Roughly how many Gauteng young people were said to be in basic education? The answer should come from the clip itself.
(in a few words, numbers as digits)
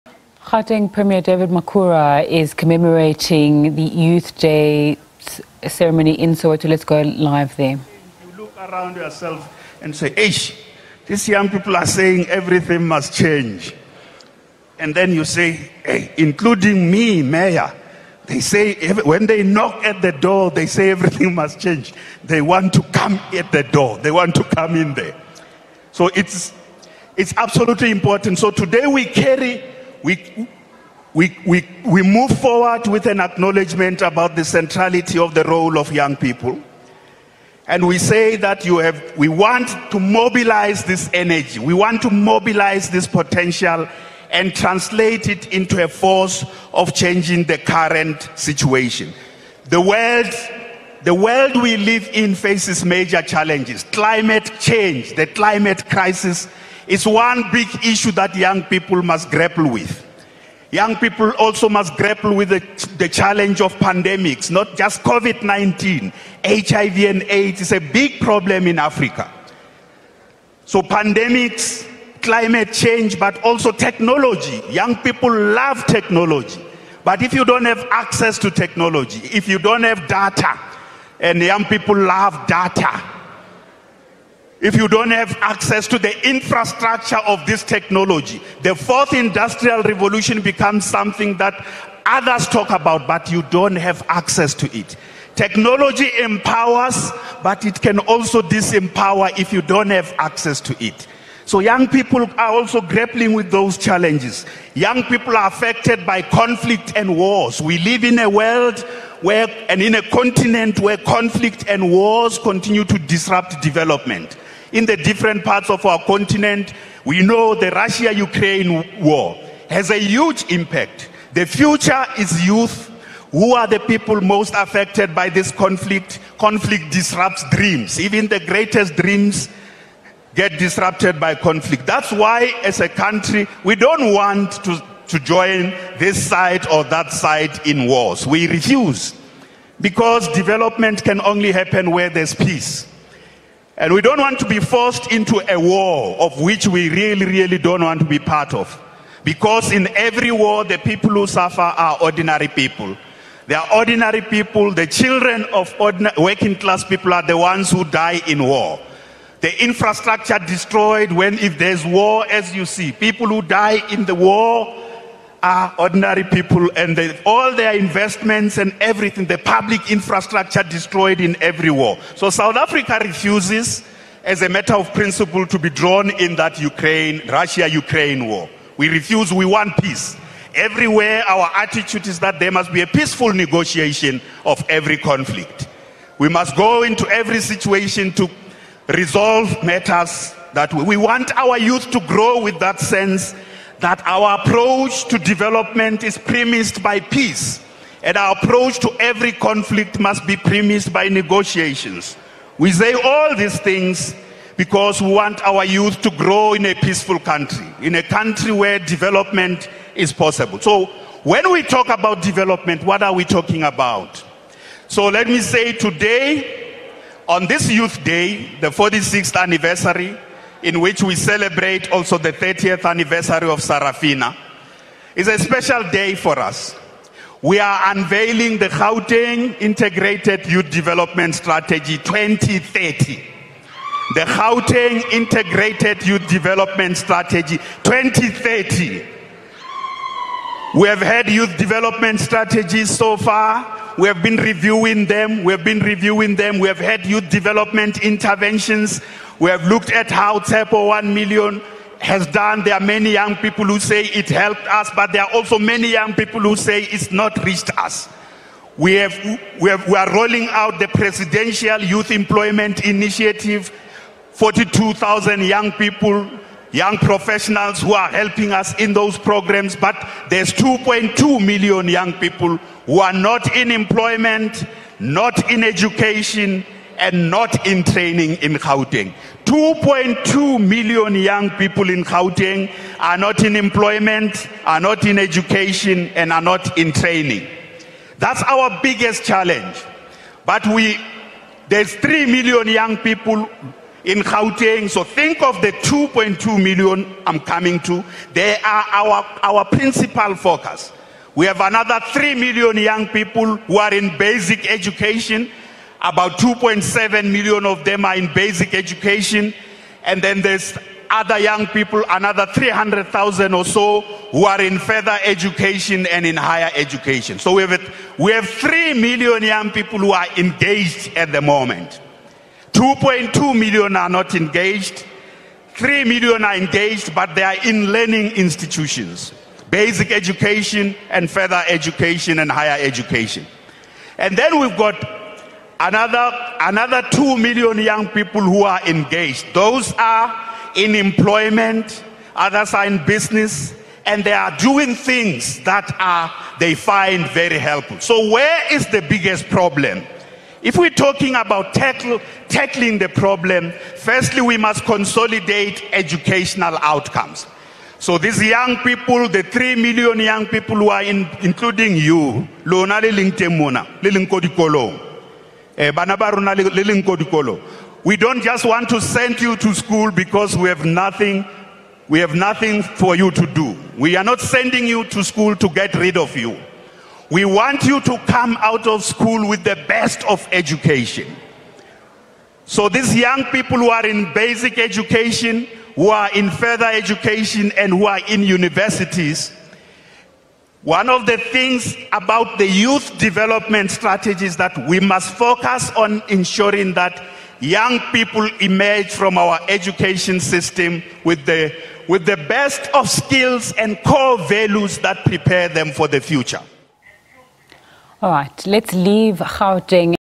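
2.7 million.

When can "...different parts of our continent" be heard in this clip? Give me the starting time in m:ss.
1:54.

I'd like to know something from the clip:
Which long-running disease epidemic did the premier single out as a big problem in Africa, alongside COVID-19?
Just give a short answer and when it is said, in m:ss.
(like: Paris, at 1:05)
HIV and AIDS, at 1:06.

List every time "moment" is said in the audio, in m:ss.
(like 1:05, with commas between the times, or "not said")
5:21.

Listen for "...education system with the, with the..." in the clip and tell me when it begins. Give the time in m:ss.
6:39.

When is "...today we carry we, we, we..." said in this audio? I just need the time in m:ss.
0:28.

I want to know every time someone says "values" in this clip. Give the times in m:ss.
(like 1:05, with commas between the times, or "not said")
6:44.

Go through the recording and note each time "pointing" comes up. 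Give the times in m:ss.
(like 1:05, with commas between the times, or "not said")
not said.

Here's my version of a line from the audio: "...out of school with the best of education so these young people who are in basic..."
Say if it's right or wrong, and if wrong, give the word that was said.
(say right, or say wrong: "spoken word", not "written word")
right.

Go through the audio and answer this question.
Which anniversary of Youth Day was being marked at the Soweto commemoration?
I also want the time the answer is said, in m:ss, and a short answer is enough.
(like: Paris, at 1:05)
46th, at 3:38.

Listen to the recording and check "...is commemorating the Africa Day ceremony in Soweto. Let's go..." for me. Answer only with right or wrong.
wrong.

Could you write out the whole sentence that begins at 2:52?
So South Africa refuses, as a matter of principle, to be drawn in that Ukraine, Russia Ukraine war.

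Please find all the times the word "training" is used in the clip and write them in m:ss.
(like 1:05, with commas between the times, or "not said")
4:37, 4:46.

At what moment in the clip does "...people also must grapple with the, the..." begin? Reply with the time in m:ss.
1:00.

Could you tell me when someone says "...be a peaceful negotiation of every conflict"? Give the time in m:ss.
3:02.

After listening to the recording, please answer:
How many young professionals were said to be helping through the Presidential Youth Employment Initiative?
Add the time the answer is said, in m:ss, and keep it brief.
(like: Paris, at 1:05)
42,000, at 4:24.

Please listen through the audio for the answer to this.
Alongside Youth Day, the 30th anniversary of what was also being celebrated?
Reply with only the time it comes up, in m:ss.
3:43.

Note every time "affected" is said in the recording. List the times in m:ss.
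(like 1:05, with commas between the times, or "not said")
1:45, 2:04.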